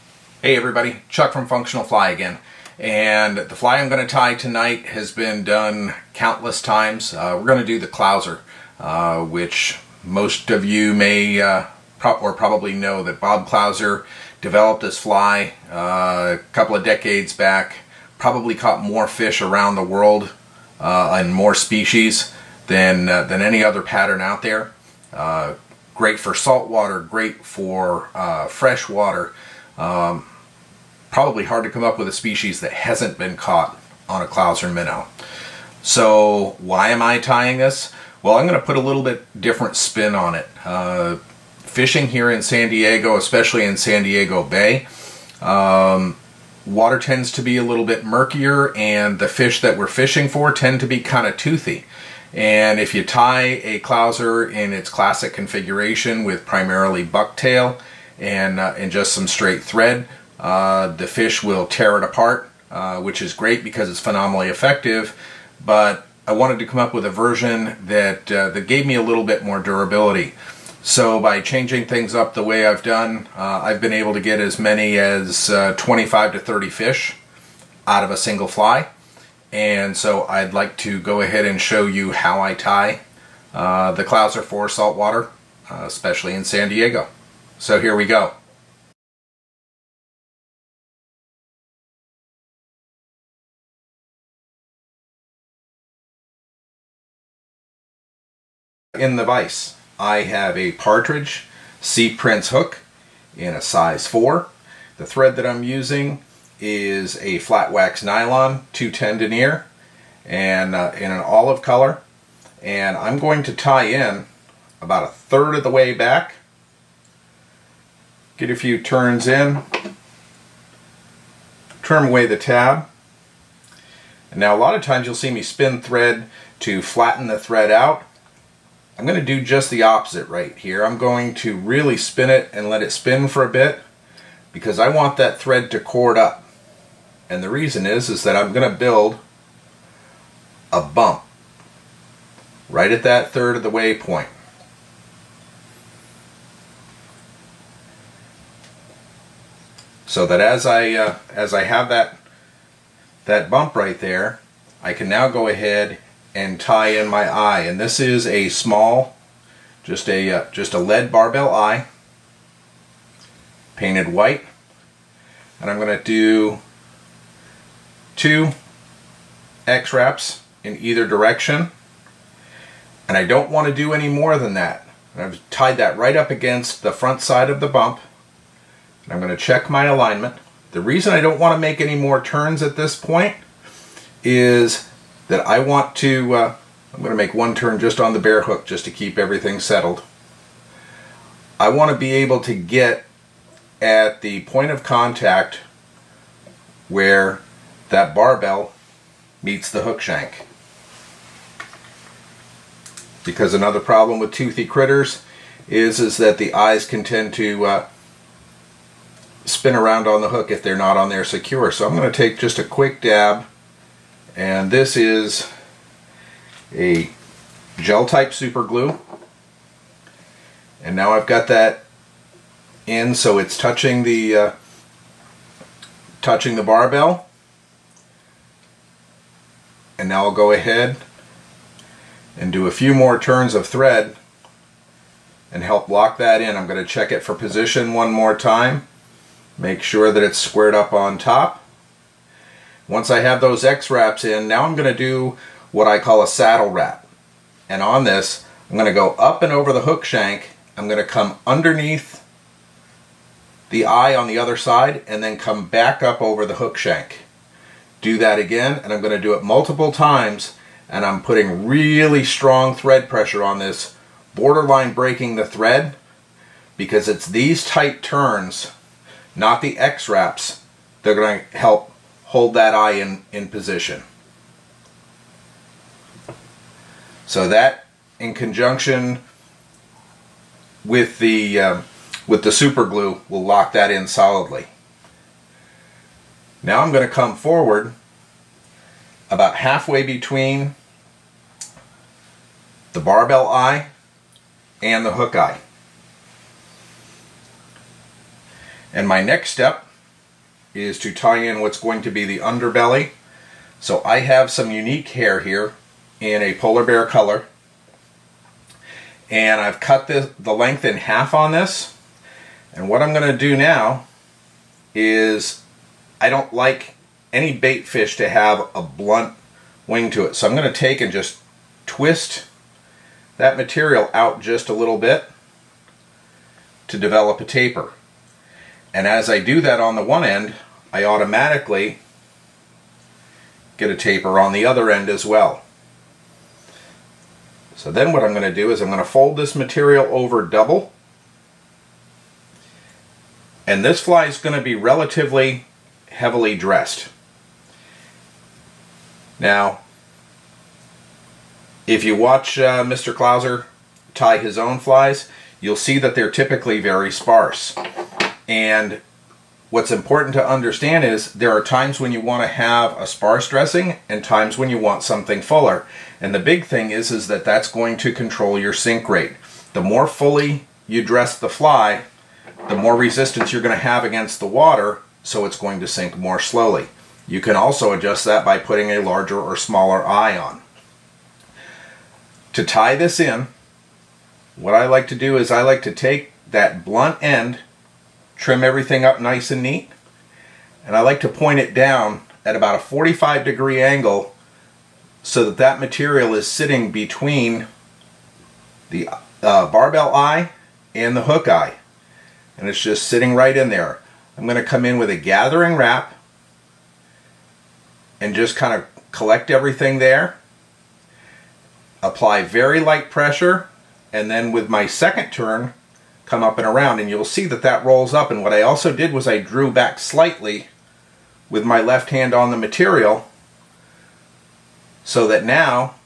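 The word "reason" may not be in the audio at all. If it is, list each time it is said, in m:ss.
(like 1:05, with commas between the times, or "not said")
2:17, 3:00.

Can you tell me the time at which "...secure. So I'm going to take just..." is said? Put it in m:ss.
3:31.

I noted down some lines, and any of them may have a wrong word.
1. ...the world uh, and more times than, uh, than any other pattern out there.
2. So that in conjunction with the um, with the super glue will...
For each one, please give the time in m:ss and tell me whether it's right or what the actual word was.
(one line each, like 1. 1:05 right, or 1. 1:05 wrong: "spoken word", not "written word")
1. 0:19 wrong: "species", not "times"
2. 4:37 right.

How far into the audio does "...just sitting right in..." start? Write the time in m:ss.
6:42.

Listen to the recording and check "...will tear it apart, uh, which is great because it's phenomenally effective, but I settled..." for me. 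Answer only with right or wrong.
wrong.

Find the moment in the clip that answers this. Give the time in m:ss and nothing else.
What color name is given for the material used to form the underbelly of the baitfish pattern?
5:06.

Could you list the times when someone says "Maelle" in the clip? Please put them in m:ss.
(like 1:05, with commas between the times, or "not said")
not said.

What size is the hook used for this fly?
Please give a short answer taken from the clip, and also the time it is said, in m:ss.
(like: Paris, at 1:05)
4, at 1:43.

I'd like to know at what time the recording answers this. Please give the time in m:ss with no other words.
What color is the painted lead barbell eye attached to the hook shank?
2:43.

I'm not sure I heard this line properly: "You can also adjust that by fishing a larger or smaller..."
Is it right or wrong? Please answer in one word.
wrong.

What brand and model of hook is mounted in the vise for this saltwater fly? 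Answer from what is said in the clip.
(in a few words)
Partridge Sea Prince.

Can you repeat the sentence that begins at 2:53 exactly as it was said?
And I don't want to do any more than that.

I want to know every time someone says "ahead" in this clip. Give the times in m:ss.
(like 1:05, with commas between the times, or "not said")
1:21, 2:35, 3:50.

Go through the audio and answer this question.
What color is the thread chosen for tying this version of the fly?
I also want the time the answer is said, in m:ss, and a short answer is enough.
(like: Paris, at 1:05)
Olive, at 1:51.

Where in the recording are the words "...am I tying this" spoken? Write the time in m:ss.
0:36.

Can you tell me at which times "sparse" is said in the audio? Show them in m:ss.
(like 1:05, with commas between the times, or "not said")
5:57, 6:03.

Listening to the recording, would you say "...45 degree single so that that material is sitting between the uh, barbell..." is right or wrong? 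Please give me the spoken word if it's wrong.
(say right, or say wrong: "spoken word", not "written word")
wrong: "angle", not "single".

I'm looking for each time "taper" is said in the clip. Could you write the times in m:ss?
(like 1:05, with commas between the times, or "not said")
5:27, 5:33.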